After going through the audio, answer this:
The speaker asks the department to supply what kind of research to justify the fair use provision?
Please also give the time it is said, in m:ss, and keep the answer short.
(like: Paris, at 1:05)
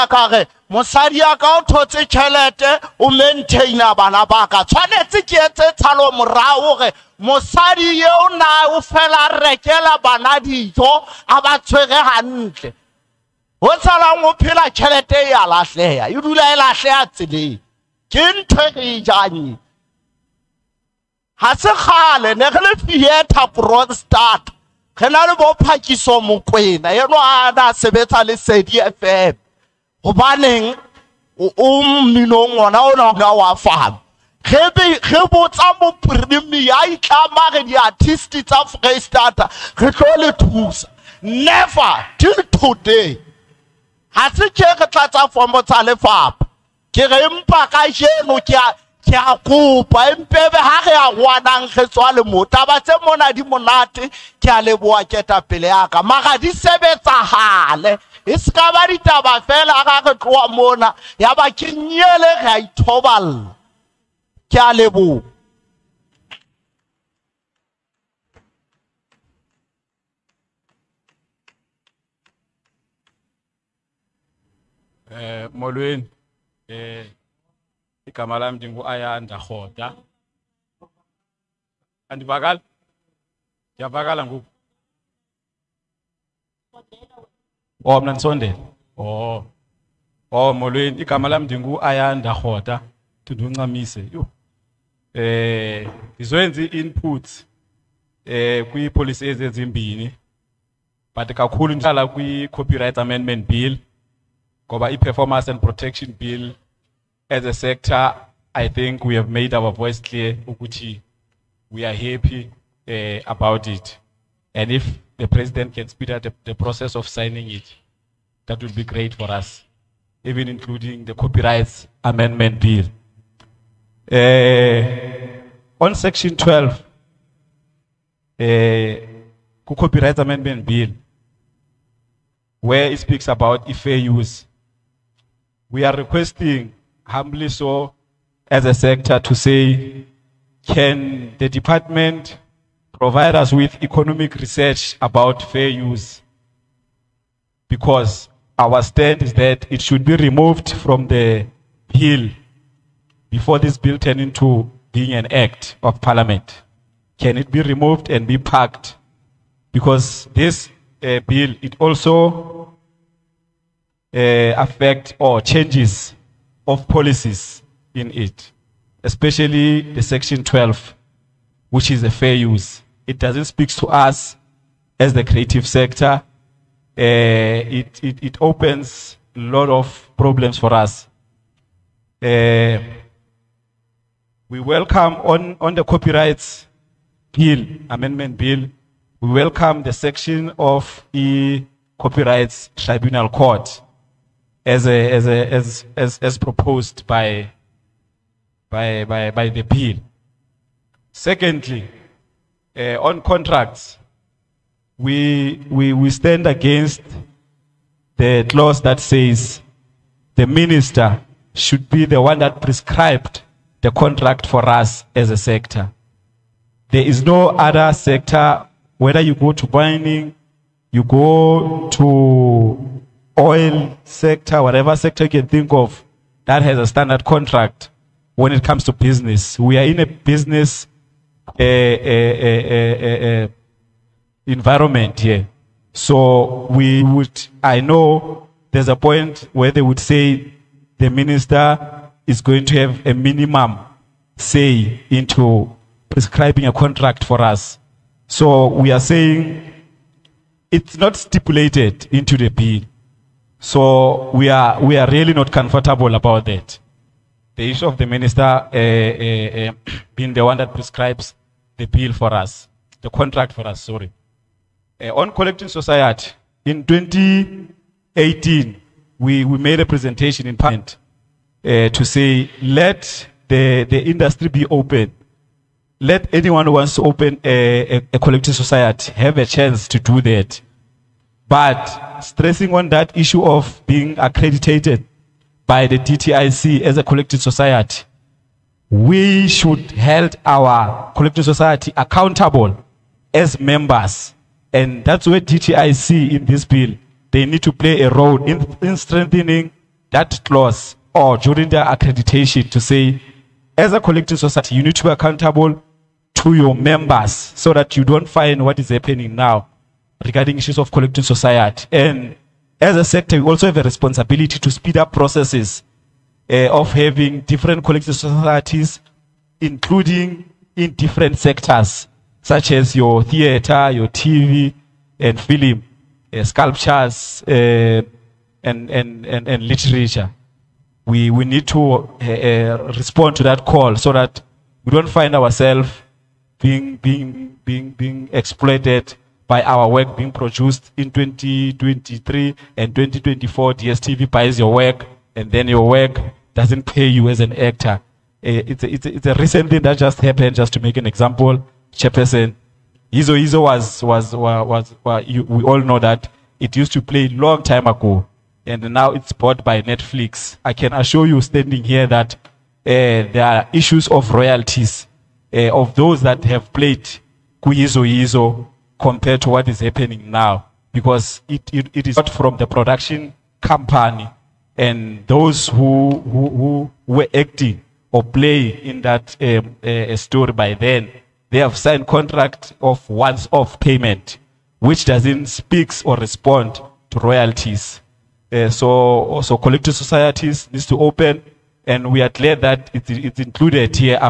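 Economic research, at 2:23.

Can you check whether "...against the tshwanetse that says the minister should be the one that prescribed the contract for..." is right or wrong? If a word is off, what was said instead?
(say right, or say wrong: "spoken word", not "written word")
wrong: "clause", not "tshwanetse".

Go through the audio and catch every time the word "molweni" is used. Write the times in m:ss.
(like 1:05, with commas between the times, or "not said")
1:15, 1:30.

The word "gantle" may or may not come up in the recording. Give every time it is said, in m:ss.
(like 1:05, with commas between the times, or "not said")
0:12.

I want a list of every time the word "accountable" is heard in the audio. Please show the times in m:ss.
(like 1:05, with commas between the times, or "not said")
4:51, 5:05.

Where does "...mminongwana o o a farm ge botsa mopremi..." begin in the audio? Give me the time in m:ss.
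0:32.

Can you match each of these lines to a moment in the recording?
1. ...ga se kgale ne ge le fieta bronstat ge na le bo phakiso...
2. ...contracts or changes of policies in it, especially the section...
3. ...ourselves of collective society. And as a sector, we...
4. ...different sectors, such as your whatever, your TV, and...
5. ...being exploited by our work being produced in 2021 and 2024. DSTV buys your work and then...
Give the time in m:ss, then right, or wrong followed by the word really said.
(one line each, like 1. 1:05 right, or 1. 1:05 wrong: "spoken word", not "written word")
1. 0:21 right
2. 2:44 wrong: "affects", not "contracts"
3. 5:10 wrong: "issues", not "ourselves"
4. 5:20 wrong: "theater", not "whatever"
5. 5:37 wrong: "2023", not "2021".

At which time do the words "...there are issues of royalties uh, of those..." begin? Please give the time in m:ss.
6:02.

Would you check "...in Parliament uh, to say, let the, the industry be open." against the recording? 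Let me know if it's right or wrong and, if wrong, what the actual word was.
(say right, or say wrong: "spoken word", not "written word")
right.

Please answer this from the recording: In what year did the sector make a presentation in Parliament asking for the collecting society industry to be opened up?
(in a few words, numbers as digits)
2018.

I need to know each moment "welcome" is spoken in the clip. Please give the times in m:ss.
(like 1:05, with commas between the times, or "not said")
3:04, 3:09.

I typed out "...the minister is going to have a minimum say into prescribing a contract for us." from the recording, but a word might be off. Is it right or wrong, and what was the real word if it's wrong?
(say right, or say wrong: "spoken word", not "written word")
right.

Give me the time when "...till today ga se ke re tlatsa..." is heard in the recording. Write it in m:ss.
0:42.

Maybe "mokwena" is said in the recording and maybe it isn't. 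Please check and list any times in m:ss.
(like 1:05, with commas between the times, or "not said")
0:26.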